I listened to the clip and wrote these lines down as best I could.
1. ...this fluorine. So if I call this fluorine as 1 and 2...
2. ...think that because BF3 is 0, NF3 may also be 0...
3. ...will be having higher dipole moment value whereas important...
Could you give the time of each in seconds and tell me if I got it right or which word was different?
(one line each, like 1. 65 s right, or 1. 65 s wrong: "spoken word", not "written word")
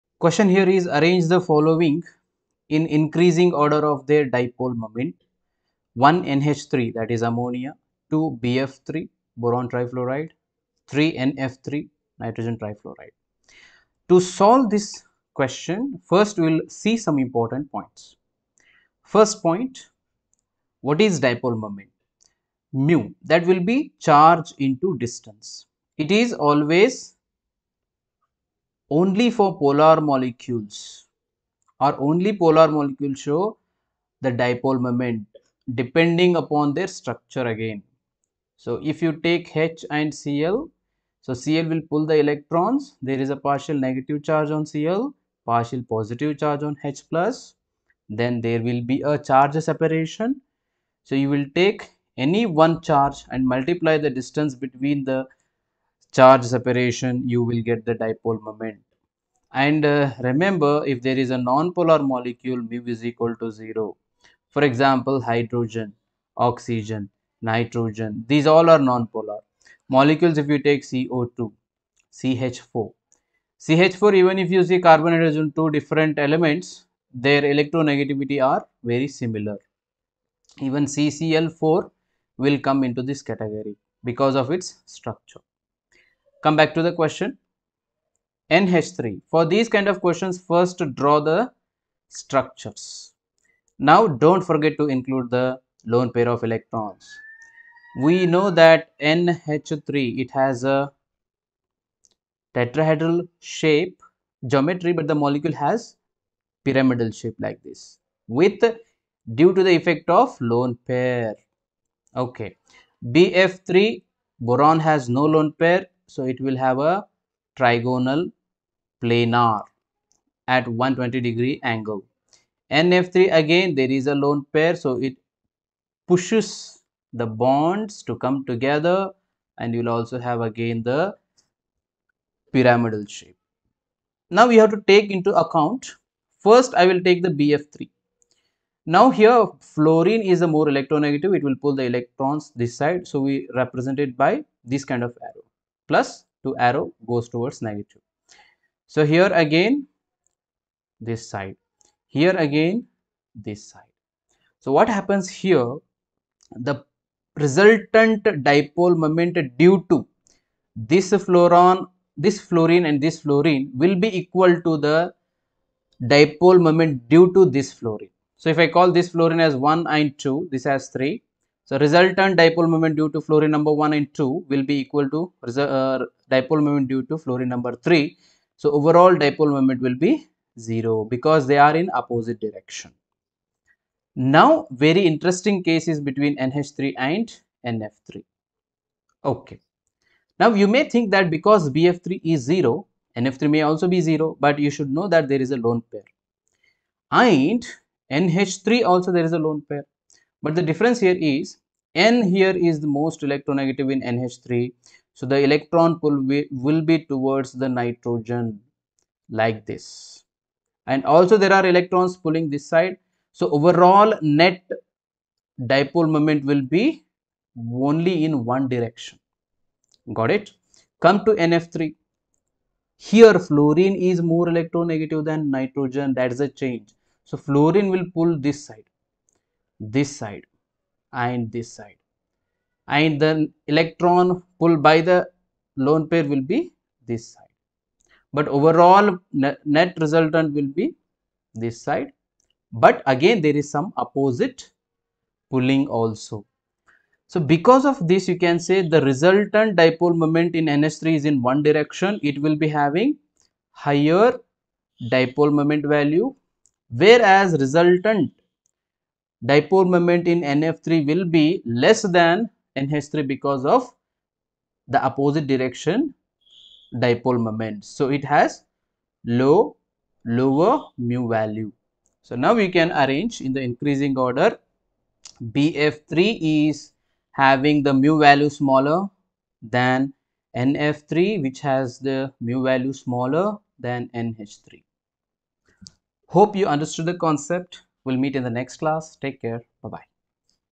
1. 167 s right
2. 190 s right
3. 252 s wrong: "resultant", not "important".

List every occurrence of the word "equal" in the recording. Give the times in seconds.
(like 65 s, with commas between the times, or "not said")
63 s, 164 s, 174 s.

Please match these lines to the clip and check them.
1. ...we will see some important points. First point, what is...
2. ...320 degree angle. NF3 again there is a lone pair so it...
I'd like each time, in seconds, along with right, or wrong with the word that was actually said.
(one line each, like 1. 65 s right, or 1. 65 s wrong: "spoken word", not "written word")
1. 16 s right
2. 120 s wrong: "120", not "320".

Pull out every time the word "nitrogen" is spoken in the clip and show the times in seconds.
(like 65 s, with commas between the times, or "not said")
12 s, 67 s, 207 s, 225 s.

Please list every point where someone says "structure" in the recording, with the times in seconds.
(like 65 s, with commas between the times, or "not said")
36 s, 84 s, 92 s.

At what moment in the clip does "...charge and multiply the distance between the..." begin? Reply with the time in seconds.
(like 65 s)
52 s.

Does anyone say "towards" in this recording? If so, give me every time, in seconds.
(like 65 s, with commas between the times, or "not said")
147 s, 207 s.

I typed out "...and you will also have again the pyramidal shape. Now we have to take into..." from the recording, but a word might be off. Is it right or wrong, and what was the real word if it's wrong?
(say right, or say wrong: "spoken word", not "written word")
right.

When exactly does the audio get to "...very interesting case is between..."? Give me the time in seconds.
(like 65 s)
184 s.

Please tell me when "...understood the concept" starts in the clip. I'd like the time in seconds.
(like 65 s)
286 s.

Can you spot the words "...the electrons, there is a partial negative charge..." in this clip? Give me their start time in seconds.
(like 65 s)
42 s.